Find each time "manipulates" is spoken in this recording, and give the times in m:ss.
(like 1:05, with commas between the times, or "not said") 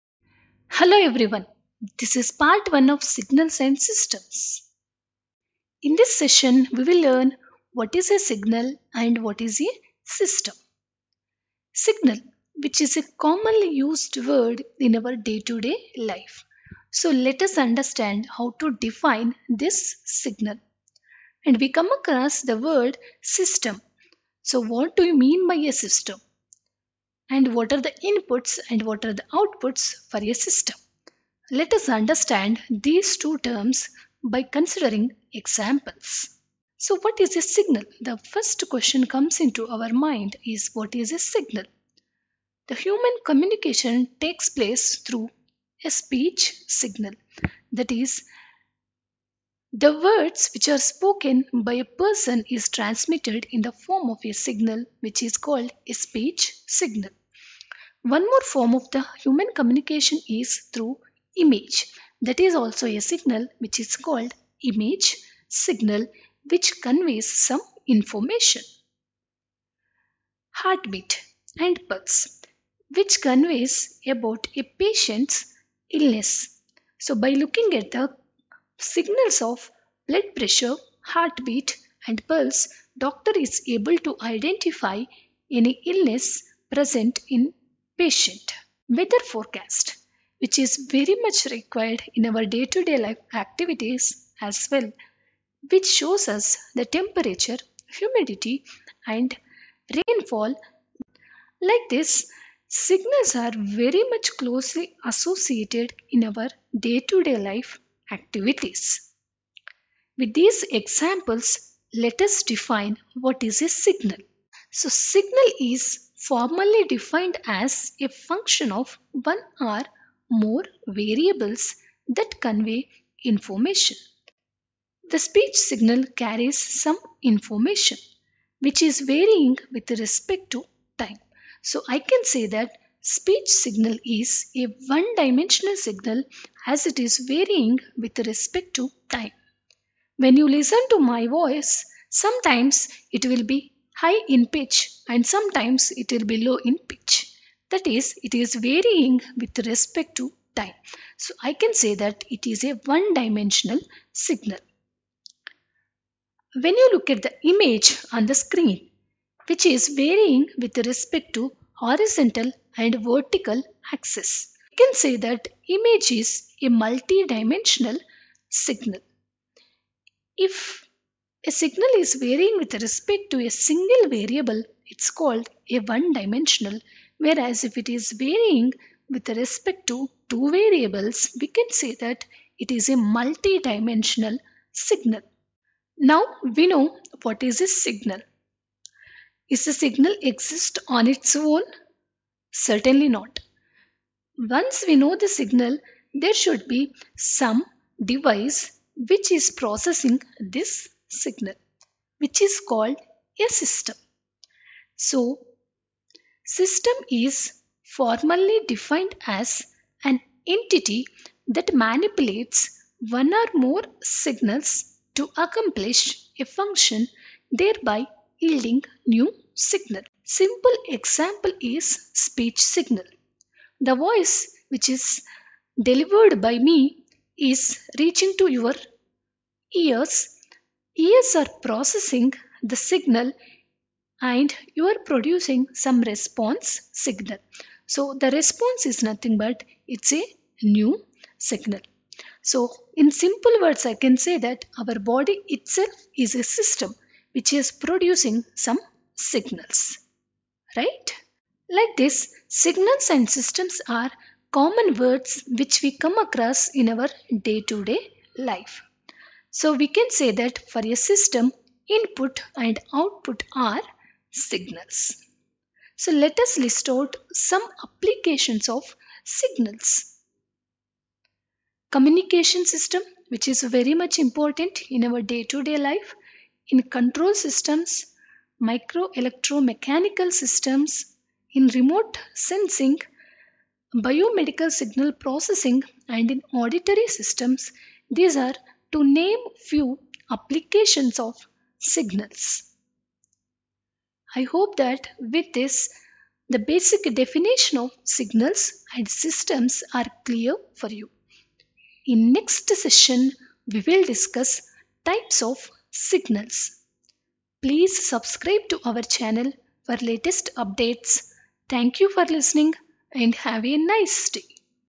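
3:31.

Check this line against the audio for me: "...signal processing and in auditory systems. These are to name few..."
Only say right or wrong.
right.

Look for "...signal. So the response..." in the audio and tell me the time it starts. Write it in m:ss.
3:56.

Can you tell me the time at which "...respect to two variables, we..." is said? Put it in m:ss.
2:59.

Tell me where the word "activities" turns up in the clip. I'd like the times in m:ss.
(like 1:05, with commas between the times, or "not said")
1:33, 1:48.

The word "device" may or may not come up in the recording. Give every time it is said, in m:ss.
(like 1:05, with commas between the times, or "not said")
3:18.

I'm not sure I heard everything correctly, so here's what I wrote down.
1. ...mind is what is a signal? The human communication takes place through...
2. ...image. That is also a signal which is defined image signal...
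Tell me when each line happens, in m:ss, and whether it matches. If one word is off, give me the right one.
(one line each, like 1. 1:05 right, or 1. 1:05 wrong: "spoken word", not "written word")
1. 0:39 right
2. 1:01 wrong: "called", not "defined".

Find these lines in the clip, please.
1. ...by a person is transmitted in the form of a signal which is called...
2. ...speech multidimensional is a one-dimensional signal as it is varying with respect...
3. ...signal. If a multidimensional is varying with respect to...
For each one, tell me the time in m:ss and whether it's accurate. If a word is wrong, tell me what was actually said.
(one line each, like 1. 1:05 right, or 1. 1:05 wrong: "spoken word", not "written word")
1. 0:51 right
2. 2:13 wrong: "signal", not "multidimensional"
3. 2:48 wrong: "signal", not "multidimensional".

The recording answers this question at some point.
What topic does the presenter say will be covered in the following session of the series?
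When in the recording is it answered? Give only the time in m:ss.
5:05.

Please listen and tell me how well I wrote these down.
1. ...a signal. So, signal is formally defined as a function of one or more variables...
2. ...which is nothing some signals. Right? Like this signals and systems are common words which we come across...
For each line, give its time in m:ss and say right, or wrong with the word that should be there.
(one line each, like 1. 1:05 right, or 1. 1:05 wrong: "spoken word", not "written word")
1. 1:53 right
2. 4:07 wrong: "producing", not "nothing".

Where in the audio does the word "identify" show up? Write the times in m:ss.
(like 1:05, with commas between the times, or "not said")
1:24.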